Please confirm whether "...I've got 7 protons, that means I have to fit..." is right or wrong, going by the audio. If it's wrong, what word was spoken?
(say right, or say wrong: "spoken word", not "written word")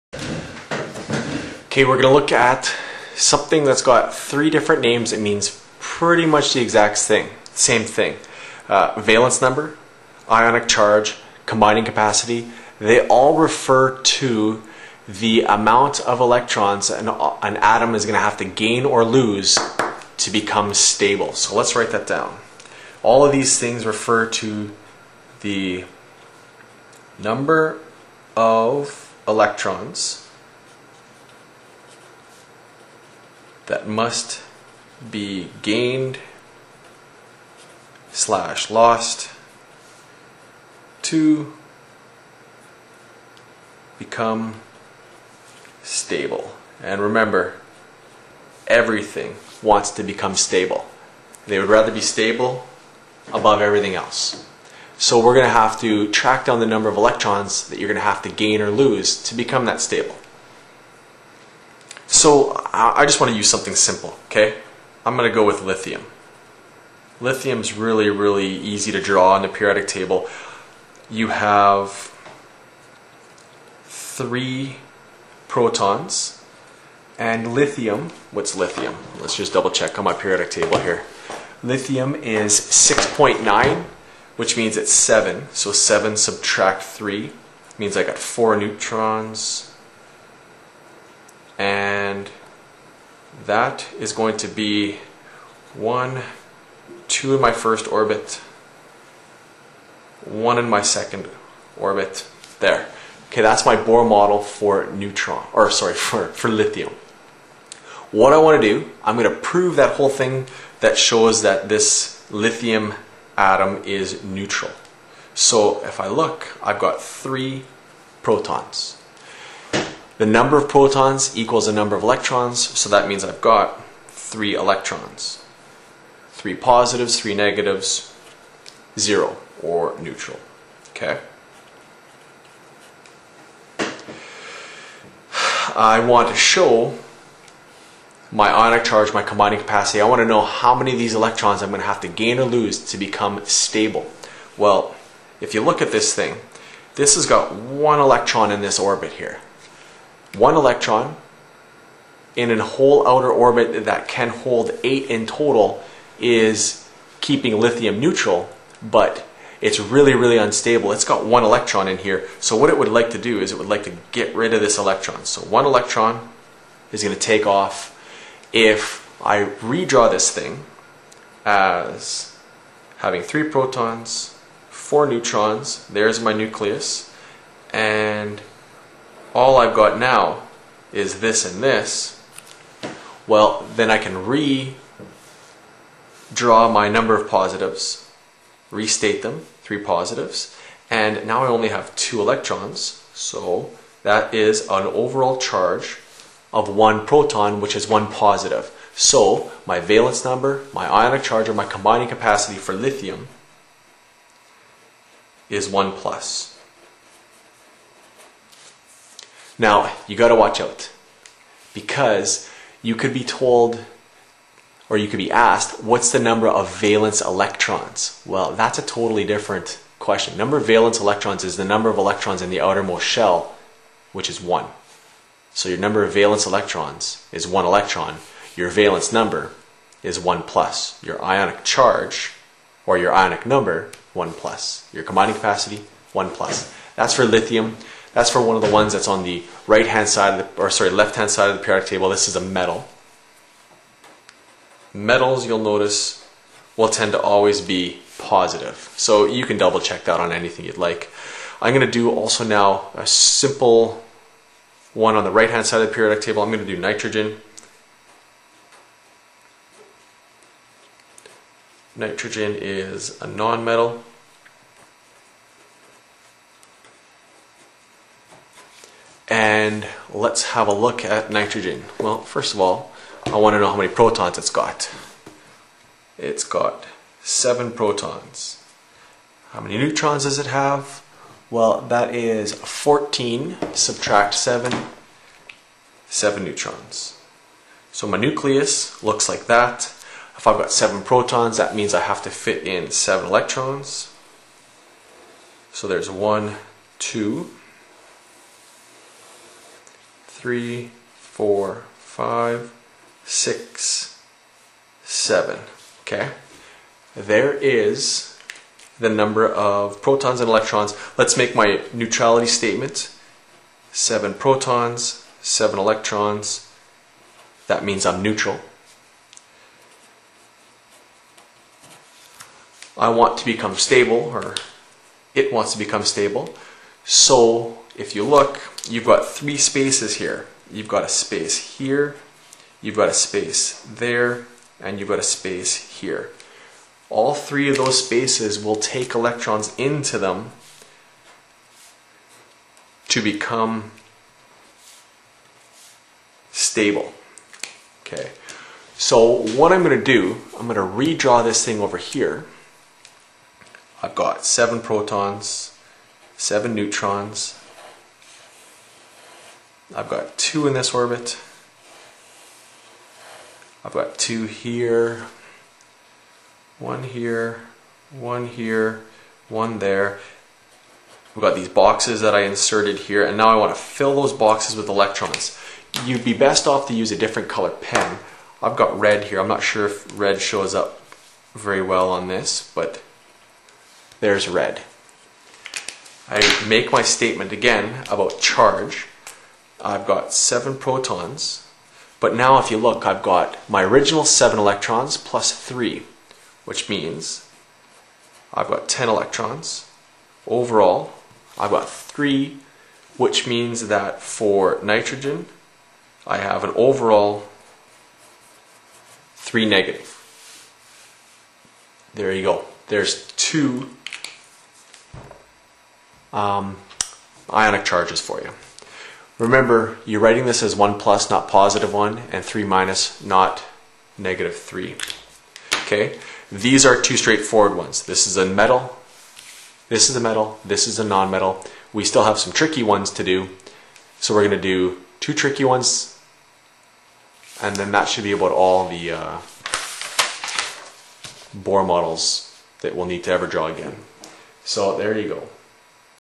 right.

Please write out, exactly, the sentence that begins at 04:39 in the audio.
How many neutrons does it have?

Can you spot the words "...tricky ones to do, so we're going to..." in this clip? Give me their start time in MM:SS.
07:12.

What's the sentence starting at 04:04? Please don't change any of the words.
Metals, you'll notice, will tend to always be positive.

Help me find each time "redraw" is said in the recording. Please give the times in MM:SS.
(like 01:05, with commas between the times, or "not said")
02:49, 03:04, 05:51.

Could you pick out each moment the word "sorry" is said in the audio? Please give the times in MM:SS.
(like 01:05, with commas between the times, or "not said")
01:45, 04:00.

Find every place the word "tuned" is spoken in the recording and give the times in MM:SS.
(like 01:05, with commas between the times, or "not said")
not said.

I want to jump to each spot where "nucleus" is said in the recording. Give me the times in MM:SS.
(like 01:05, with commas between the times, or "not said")
02:56, 04:48.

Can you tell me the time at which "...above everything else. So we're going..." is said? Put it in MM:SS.
00:53.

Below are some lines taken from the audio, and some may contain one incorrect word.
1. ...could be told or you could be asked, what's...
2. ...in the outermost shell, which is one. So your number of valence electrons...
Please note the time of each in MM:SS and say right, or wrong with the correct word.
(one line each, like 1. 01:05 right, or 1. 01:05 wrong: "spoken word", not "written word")
1. 03:32 right
2. 03:42 right.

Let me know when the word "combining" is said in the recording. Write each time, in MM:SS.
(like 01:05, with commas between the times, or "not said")
00:11, 02:19, 03:21, 03:55.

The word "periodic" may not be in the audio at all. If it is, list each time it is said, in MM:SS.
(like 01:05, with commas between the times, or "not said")
01:09, 01:20, 04:01, 04:15.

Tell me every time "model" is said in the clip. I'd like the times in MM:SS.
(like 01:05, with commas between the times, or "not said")
01:44, 07:21.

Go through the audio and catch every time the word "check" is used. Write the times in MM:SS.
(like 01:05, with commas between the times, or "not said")
01:19, 04:09.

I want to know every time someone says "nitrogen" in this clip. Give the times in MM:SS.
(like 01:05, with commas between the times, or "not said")
04:16, 04:21, 04:31, 06:44.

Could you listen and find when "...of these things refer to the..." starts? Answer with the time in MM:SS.
00:23.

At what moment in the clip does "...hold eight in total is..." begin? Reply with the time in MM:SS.
02:34.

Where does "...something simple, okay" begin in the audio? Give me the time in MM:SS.
01:03.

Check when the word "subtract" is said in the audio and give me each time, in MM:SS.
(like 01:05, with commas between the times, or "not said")
01:26, 04:43.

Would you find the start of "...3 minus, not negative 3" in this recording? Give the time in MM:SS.
07:02.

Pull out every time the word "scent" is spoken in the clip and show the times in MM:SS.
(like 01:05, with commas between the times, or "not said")
not said.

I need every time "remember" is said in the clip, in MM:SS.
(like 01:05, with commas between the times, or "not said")
00:47, 06:59.